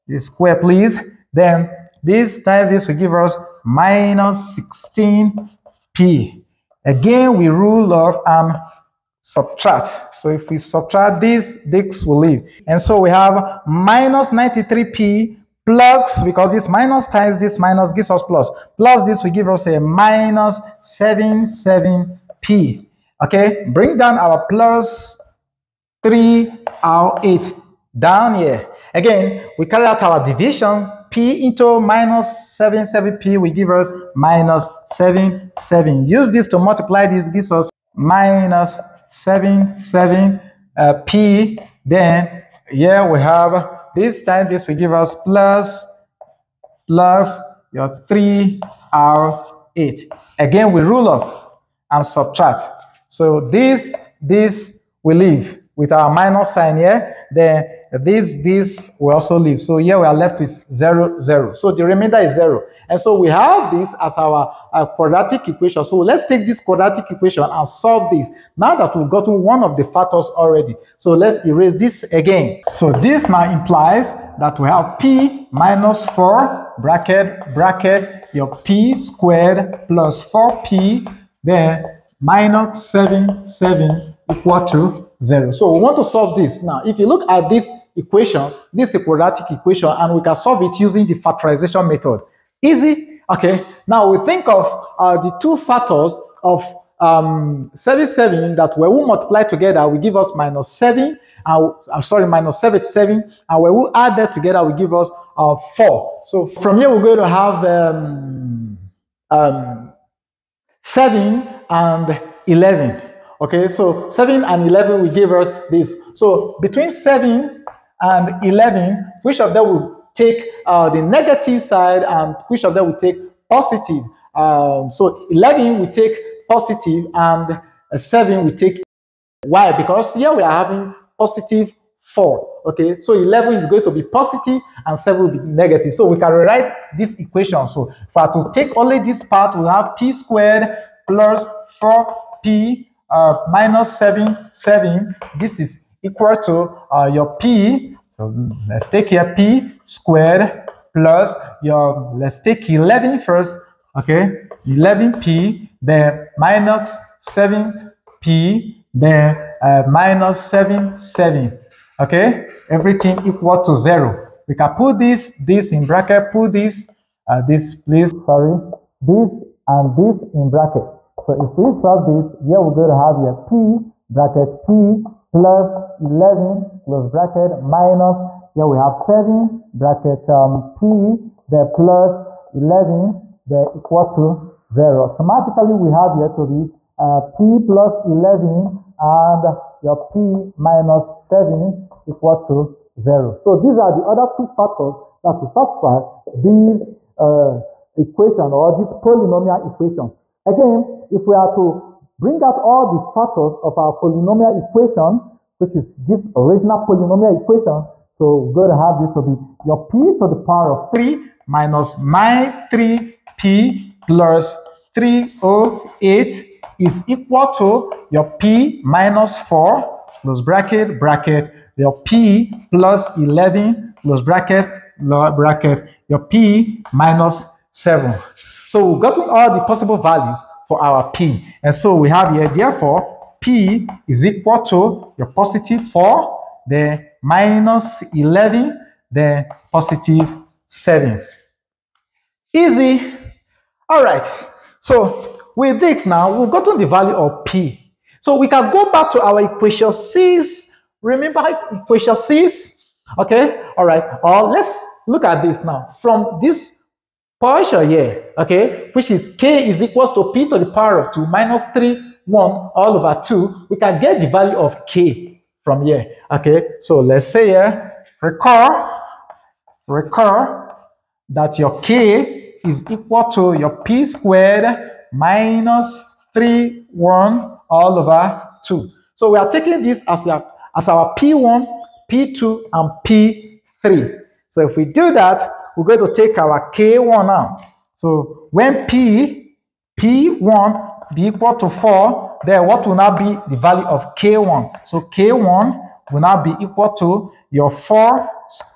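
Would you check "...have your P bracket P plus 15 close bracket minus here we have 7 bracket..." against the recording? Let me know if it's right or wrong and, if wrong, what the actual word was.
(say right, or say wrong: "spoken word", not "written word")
wrong: "11", not "15".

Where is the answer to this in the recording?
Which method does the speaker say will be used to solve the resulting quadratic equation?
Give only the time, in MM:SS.
01:31.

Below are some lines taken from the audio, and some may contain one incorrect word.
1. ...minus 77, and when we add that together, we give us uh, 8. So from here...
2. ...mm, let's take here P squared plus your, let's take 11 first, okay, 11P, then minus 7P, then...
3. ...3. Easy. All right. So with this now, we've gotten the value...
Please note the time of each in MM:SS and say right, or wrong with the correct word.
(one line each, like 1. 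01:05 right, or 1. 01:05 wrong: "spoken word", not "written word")
1. 01:42 wrong: "4", not "8"
2. 02:28 right
3. 04:00 wrong: "7", not "3".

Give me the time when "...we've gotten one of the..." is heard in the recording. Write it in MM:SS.
01:08.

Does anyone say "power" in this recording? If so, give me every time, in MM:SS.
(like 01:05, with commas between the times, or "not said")
03:30, 04:20.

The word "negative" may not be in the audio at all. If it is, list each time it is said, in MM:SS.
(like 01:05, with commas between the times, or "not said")
02:01, 02:15.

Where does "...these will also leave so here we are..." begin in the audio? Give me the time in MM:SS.
00:58.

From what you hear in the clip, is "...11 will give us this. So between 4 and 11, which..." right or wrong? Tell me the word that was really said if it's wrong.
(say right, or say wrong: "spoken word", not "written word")
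wrong: "7", not "4".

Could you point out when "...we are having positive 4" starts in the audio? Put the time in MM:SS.
02:10.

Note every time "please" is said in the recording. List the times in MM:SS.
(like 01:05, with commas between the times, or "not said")
00:00, 02:47.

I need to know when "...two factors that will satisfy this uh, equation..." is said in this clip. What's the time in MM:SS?
03:14.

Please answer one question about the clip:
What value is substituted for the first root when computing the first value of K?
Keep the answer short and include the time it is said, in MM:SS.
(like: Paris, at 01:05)
4, at 04:49.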